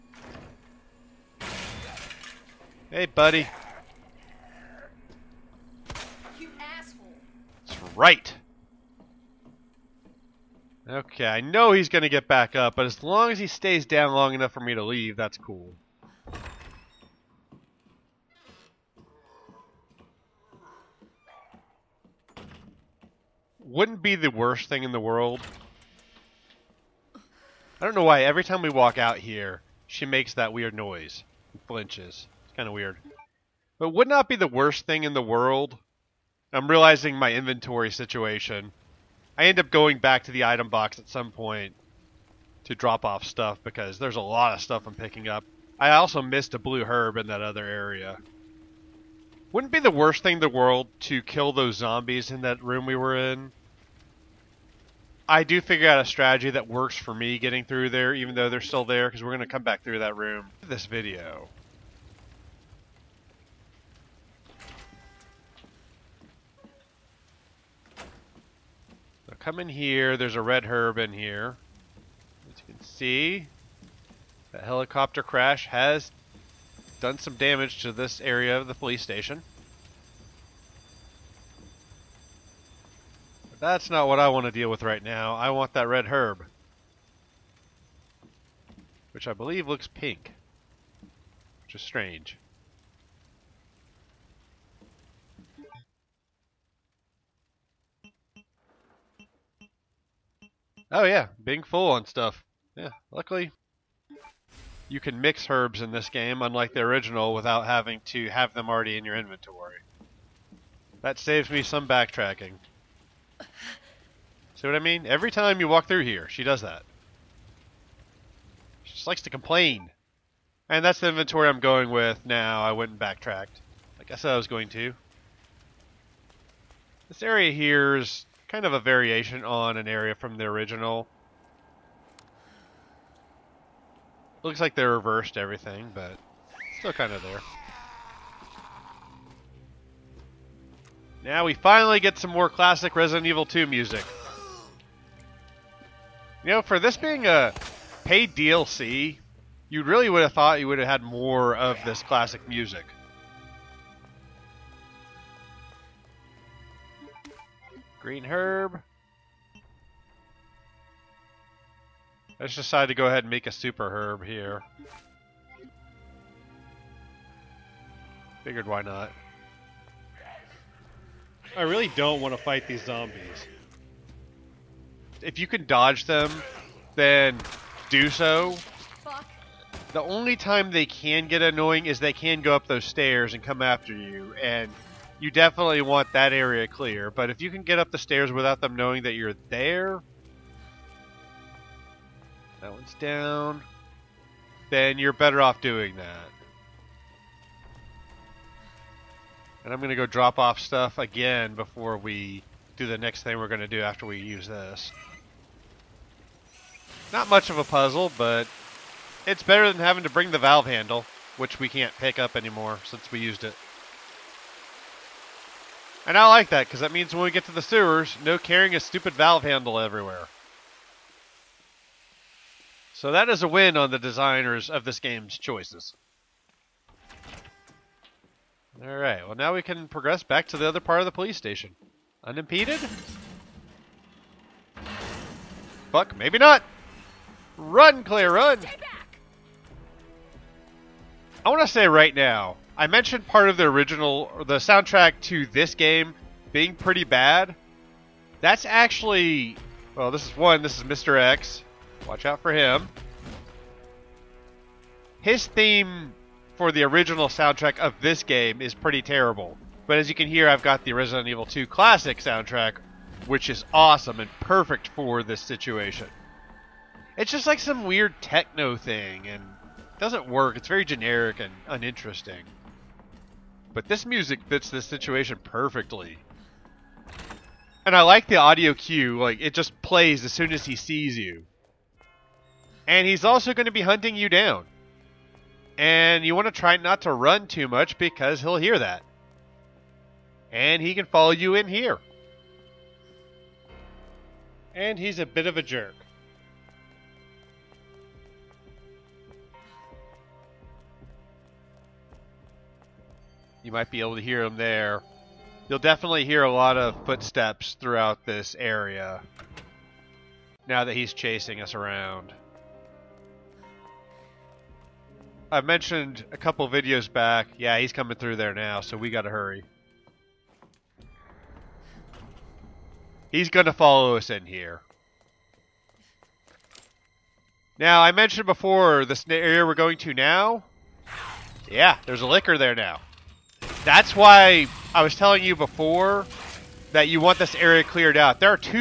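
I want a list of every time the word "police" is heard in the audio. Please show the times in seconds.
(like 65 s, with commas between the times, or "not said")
78 s, 231 s.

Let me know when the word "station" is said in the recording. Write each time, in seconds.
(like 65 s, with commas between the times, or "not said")
79 s, 231 s.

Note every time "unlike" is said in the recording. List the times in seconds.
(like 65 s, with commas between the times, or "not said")
106 s.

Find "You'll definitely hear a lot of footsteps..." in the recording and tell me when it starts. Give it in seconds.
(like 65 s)
305 s.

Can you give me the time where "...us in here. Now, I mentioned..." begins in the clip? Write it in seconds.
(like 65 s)
324 s.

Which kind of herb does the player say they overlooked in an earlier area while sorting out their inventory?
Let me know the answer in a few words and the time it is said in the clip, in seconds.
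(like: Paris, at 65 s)
blue herb, at 46 s.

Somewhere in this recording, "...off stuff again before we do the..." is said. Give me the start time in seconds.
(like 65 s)
200 s.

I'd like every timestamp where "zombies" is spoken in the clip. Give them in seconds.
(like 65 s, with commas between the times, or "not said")
51 s, 172 s.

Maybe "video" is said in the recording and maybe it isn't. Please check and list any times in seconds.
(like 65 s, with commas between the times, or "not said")
60 s, 316 s.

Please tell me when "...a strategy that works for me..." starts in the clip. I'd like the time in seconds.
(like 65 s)
56 s.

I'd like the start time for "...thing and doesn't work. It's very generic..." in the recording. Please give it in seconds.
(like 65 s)
268 s.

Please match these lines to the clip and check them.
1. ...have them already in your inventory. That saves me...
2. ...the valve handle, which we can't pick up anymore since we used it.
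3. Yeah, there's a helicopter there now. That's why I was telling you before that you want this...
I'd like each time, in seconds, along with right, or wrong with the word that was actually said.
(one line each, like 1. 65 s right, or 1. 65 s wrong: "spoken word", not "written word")
1. 108 s right
2. 210 s right
3. 331 s wrong: "licker", not "helicopter".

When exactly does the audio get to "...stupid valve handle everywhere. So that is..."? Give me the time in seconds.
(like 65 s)
218 s.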